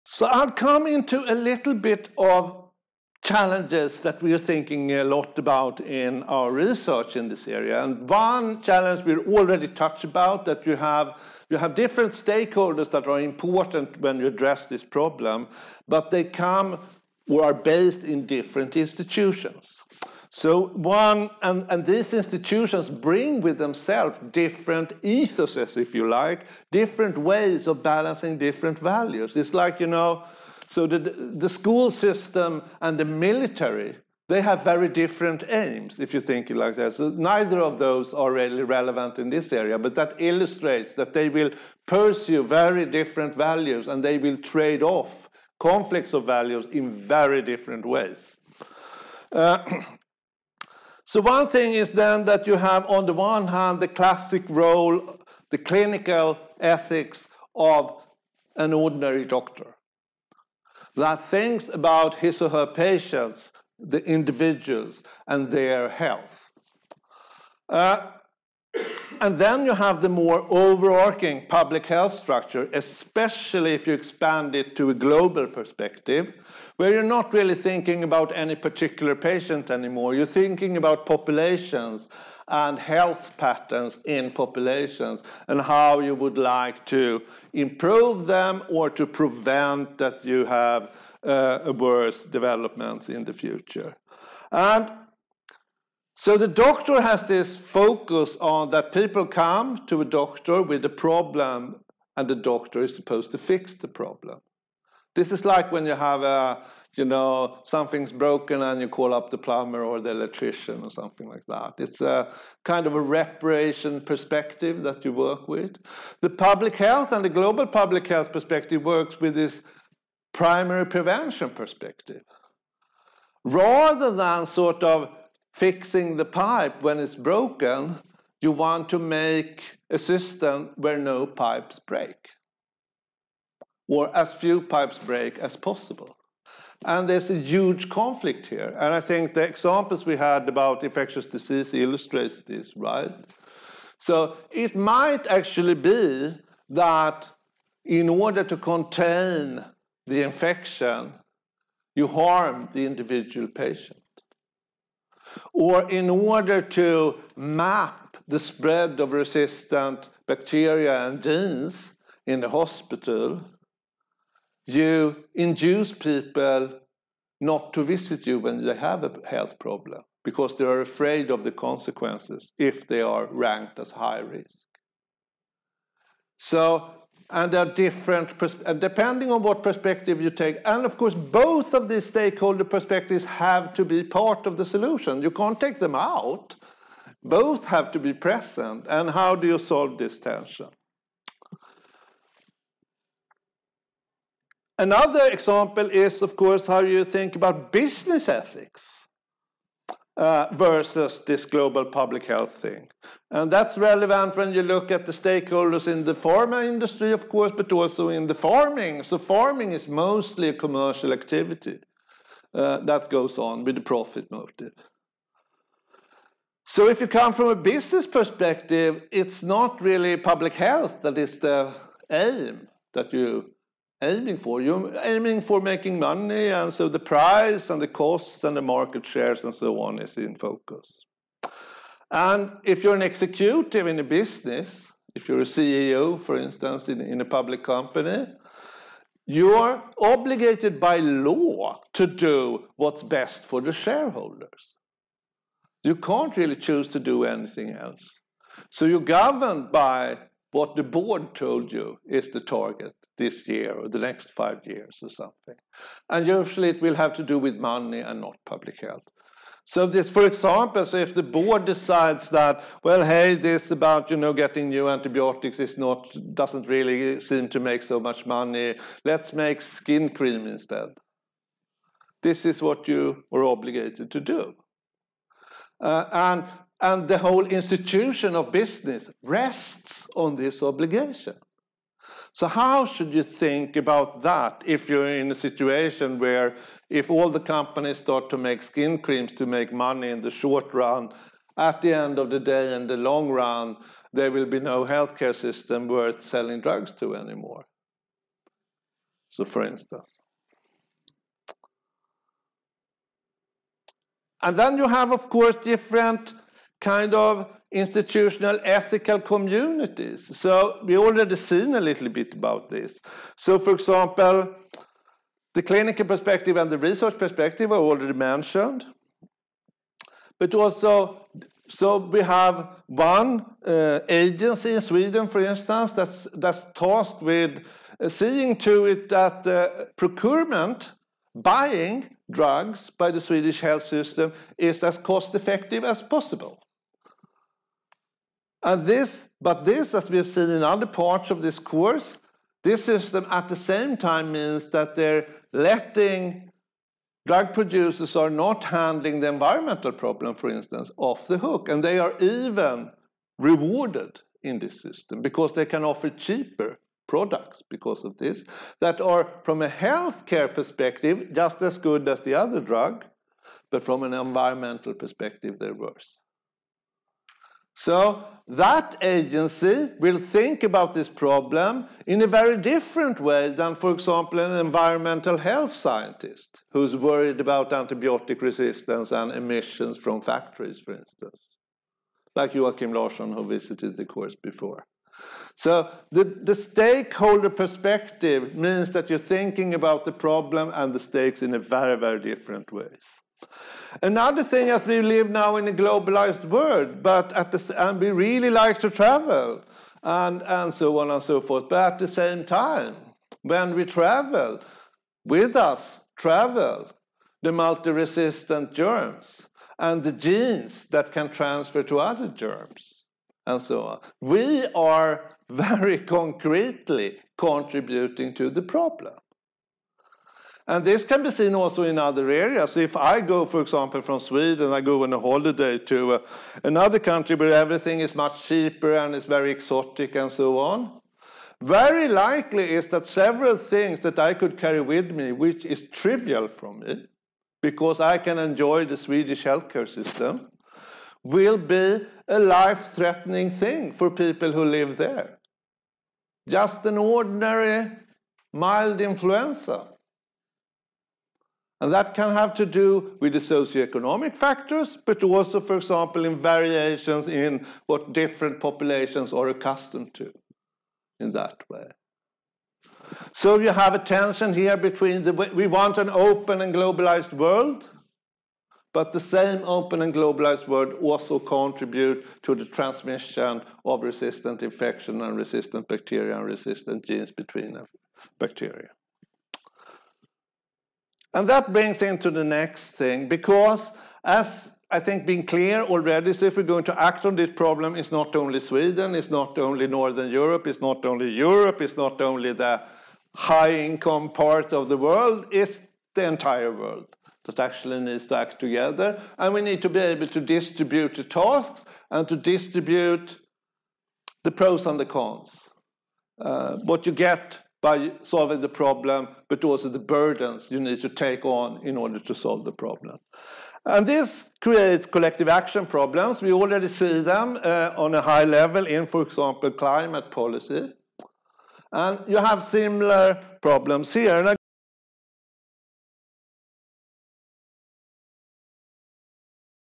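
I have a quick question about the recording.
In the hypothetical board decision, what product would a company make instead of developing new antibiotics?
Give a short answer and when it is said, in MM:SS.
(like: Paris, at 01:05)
Skin cream, at 04:29.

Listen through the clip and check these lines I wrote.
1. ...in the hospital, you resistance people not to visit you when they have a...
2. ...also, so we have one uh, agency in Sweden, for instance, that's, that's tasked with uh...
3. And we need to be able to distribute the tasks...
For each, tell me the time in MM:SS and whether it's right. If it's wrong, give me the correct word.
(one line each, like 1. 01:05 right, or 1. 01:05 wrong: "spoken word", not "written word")
1. 02:42 wrong: "induce", not "resistance"
2. 05:20 right
3. 08:19 right.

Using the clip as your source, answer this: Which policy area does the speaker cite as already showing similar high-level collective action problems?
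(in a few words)
Climate policy.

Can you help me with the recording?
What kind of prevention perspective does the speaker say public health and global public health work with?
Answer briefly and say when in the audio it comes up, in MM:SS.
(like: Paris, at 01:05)
Primary prevention, at 02:00.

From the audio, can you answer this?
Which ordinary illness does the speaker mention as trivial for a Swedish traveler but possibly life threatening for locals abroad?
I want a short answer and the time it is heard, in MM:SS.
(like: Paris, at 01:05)
Mild influenza, at 07:28.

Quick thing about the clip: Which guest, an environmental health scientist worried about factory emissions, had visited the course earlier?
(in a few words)
Joakim Larsson.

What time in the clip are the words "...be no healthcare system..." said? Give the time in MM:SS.
04:54.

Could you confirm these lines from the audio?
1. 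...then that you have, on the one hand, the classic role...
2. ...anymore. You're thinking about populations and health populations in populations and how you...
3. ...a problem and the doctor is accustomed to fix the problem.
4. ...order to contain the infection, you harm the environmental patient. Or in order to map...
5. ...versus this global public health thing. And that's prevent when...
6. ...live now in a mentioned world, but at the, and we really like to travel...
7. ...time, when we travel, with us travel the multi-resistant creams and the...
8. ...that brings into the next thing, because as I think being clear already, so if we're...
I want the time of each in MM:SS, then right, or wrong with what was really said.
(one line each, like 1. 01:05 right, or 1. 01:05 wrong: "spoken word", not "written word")
1. 00:51 right
2. 01:19 wrong: "patterns", not "populations"
3. 01:40 wrong: "supposed", not "accustomed"
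4. 02:28 wrong: "individual", not "environmental"
5. 03:20 wrong: "relevant", not "prevent"
6. 06:35 wrong: "globalized", not "mentioned"
7. 06:42 wrong: "germs", not "creams"
8. 08:01 right.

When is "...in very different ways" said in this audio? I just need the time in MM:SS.
00:46.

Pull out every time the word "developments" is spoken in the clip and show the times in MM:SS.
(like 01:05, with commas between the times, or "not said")
01:32.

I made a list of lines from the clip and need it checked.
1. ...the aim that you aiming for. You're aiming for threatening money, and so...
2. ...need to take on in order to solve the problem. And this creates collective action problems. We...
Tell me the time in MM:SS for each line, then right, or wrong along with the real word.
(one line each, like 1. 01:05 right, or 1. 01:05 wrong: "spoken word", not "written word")
1. 03:41 wrong: "making", not "threatening"
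2. 08:30 right.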